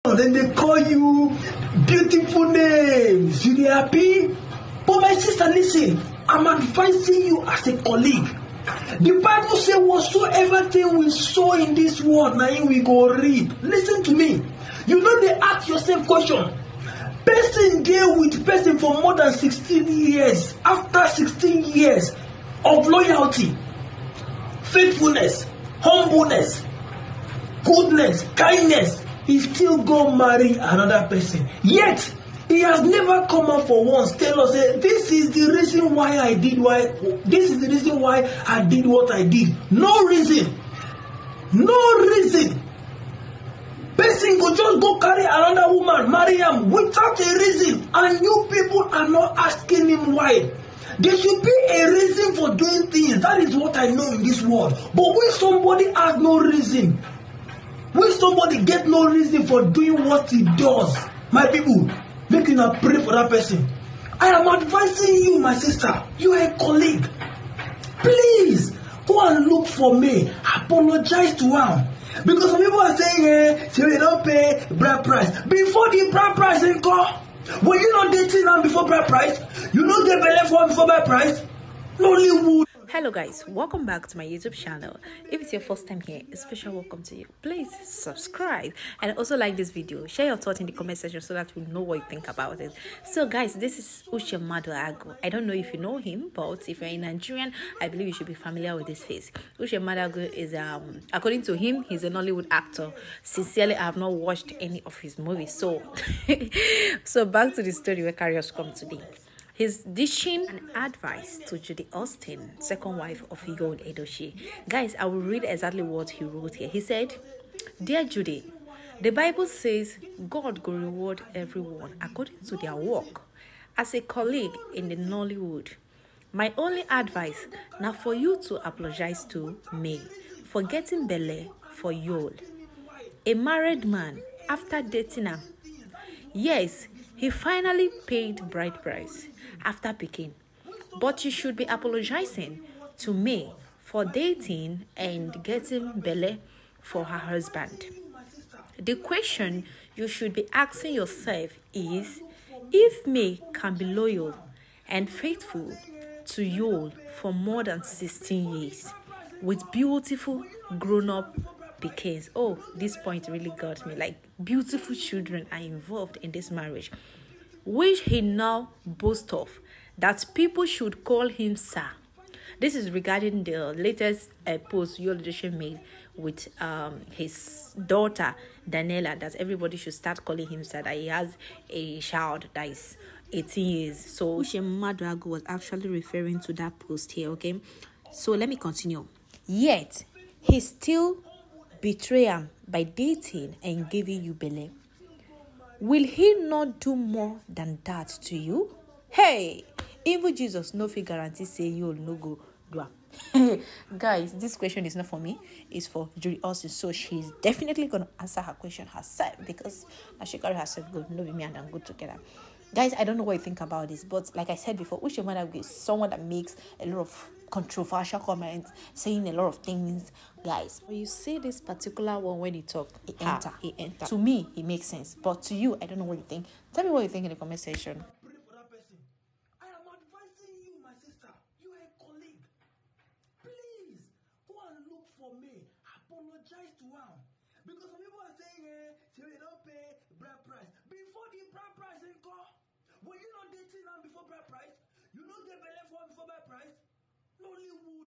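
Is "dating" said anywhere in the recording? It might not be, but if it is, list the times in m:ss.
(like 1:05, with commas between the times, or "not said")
1:18, 2:14, 2:24, 3:12, 4:03.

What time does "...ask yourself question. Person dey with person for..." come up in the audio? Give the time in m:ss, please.
0:15.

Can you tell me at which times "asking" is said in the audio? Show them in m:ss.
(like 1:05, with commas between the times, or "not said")
0:49, 2:30.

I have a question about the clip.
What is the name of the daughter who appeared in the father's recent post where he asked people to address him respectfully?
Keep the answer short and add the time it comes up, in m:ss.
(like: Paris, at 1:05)
Daniela, at 2:58.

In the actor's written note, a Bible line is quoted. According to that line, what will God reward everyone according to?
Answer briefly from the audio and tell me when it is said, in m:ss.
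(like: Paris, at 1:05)
their work, at 2:02.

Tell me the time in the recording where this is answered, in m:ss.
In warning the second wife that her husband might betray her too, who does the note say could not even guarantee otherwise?
3:20.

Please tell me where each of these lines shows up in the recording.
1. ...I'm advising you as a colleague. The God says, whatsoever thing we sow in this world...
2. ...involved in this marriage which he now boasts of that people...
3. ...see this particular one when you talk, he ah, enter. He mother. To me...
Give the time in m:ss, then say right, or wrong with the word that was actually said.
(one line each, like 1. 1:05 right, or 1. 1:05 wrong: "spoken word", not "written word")
1. 0:06 wrong: "Bible", not "God"
2. 2:45 right
3. 3:41 wrong: "enter", not "mother".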